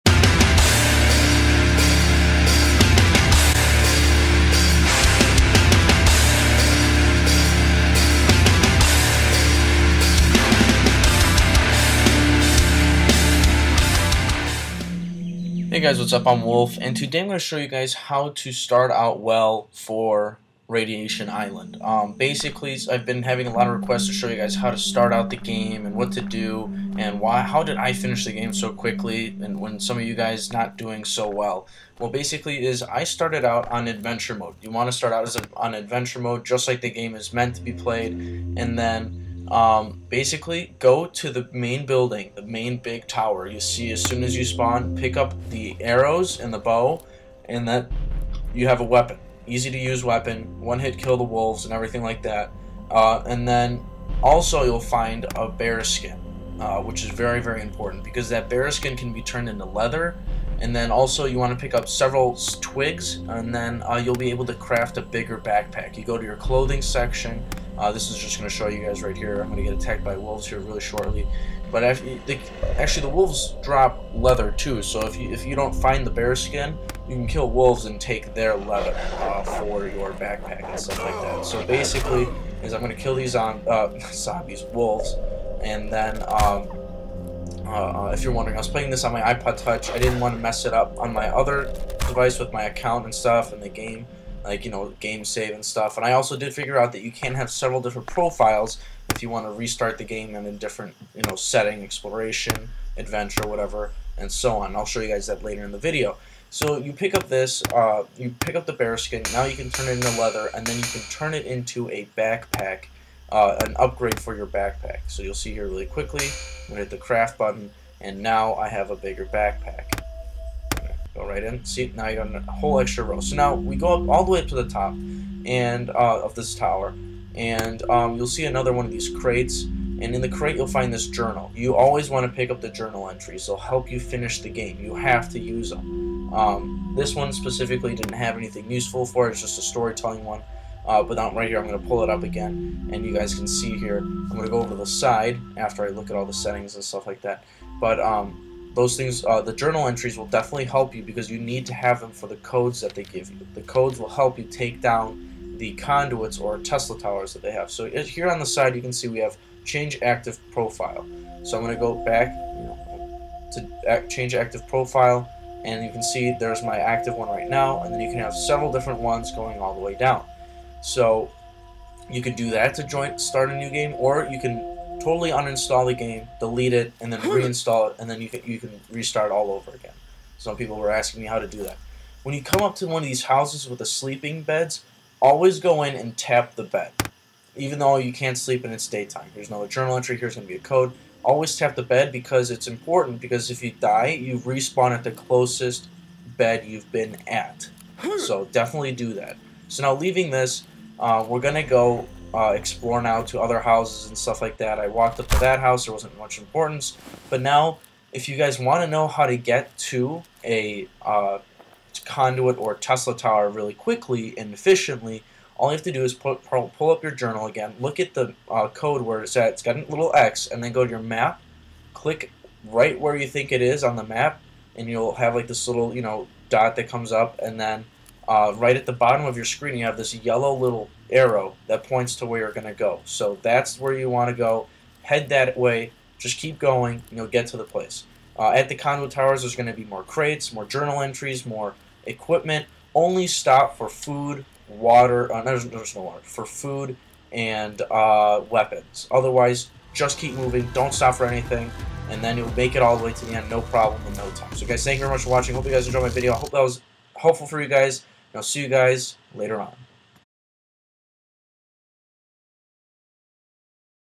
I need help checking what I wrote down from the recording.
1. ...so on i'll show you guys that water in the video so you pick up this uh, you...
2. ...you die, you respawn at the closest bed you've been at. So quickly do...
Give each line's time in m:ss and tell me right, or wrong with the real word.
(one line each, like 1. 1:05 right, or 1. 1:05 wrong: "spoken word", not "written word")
1. 1:44 wrong: "later", not "water"
2. 3:13 wrong: "definitely", not "quickly".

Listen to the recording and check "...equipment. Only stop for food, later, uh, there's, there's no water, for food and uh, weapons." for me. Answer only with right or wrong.
wrong.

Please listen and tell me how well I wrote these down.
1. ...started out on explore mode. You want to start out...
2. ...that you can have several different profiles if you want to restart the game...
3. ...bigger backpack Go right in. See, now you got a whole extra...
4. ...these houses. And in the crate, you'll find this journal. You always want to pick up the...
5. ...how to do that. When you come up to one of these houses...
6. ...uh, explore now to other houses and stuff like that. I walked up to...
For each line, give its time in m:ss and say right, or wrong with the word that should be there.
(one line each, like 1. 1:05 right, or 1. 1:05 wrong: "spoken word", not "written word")
1. 0:33 wrong: "adventure", not "explore"
2. 1:36 right
3. 1:58 right
4. 2:08 wrong: "crates", not "houses"
5. 3:01 right
6. 3:22 right.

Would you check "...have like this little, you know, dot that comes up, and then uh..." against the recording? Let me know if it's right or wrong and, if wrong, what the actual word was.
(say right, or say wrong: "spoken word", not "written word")
right.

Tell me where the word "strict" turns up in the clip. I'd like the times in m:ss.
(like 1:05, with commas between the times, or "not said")
not said.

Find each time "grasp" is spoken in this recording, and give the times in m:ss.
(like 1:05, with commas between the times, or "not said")
not said.